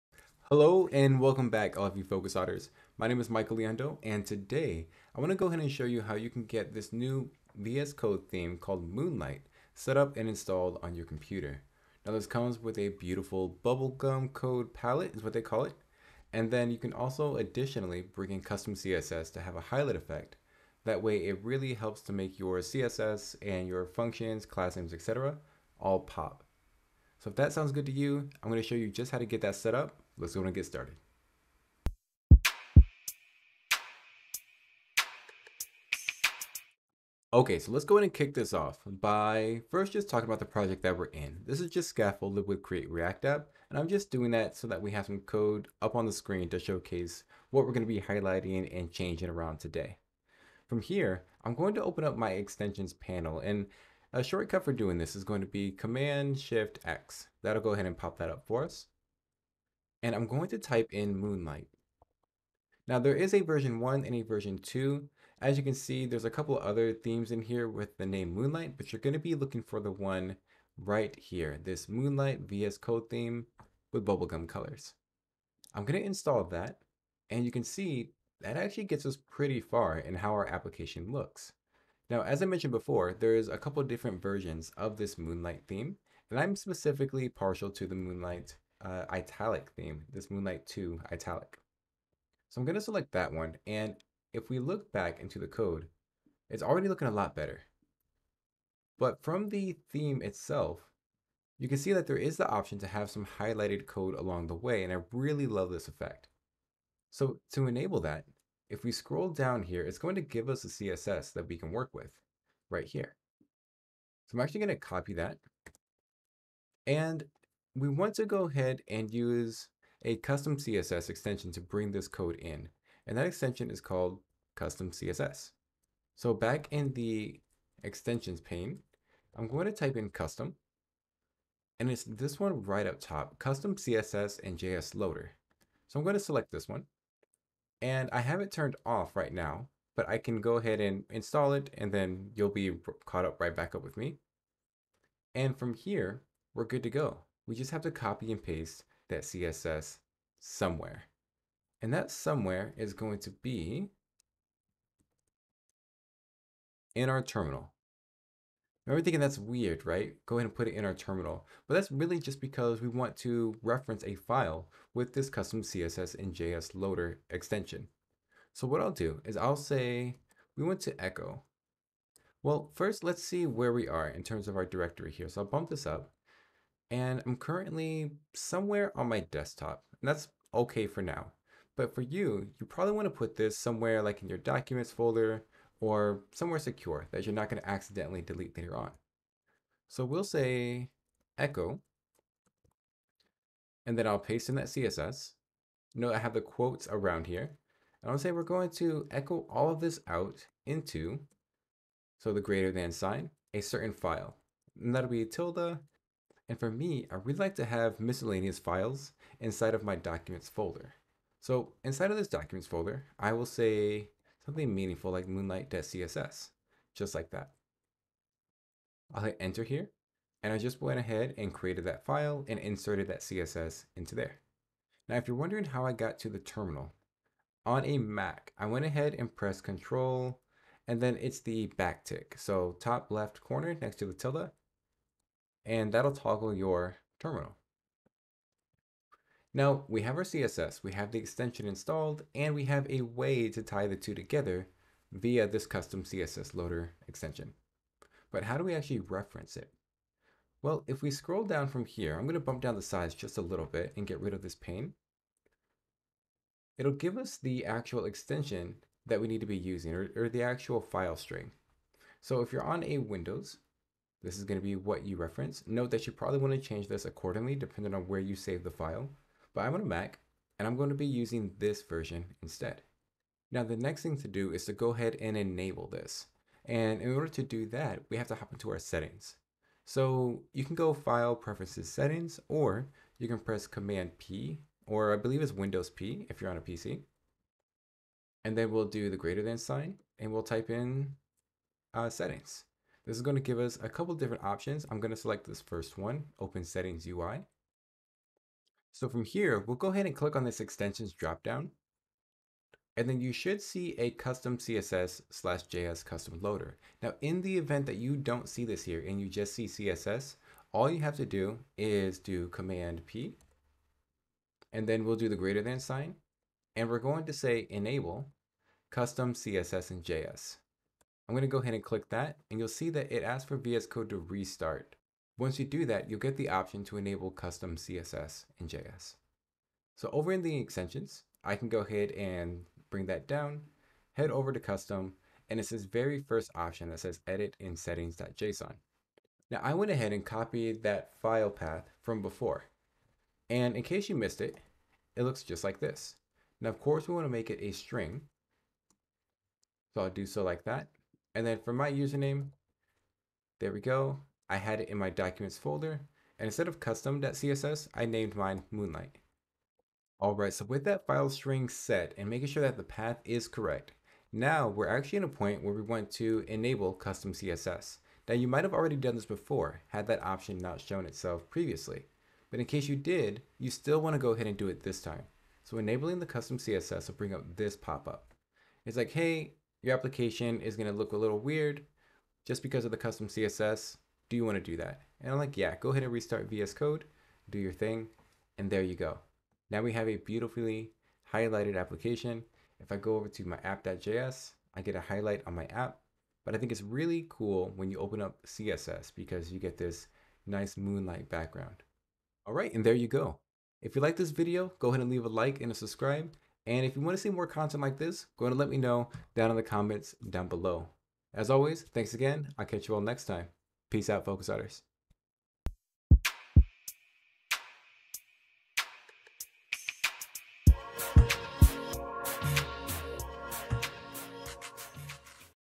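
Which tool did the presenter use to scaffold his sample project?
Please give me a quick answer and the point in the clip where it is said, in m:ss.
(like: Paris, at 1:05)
Create React App, at 0:42.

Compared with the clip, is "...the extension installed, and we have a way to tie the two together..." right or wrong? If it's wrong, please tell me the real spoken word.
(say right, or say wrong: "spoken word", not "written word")
right.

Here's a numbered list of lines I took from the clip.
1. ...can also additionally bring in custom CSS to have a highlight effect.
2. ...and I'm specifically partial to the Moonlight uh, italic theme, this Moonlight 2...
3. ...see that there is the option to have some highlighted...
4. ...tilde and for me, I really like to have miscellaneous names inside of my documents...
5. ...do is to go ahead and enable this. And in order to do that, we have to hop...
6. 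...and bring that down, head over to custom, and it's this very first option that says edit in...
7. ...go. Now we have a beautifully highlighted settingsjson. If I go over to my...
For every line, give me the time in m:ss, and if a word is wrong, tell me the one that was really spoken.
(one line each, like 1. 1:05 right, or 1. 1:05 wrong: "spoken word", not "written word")
1. 0:16 right
2. 1:26 right
3. 1:41 right
4. 3:25 wrong: "files", not "names"
5. 4:34 right
6. 5:32 right
7. 6:28 wrong: "application", not "settingsjson".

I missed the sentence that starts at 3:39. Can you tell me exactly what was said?
I'll hit enter here, and I just went ahead and created that file and inserted that CSS into there.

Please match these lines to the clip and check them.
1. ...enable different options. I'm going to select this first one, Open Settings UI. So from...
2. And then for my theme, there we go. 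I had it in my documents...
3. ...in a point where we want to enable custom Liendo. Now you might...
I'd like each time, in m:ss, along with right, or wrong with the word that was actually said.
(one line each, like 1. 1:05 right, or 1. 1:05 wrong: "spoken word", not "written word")
1. 4:53 wrong: "couple", not "enable"
2. 5:51 wrong: "username", not "theme"
3. 6:05 wrong: "CSS", not "Liendo".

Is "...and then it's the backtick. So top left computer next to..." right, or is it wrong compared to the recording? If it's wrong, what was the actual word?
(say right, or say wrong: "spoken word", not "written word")
wrong: "corner", not "computer".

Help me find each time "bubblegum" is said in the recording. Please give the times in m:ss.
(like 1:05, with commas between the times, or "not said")
0:13, 1:14.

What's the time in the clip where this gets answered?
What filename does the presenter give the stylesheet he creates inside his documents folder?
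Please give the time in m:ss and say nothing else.
3:35.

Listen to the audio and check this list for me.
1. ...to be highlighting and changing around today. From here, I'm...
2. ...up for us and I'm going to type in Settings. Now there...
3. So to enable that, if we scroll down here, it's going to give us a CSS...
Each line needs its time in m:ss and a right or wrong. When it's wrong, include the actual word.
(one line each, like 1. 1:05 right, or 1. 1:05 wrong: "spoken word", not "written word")
1. 0:47 right
2. 0:58 wrong: "Moonlight", not "Settings"
3. 1:47 right.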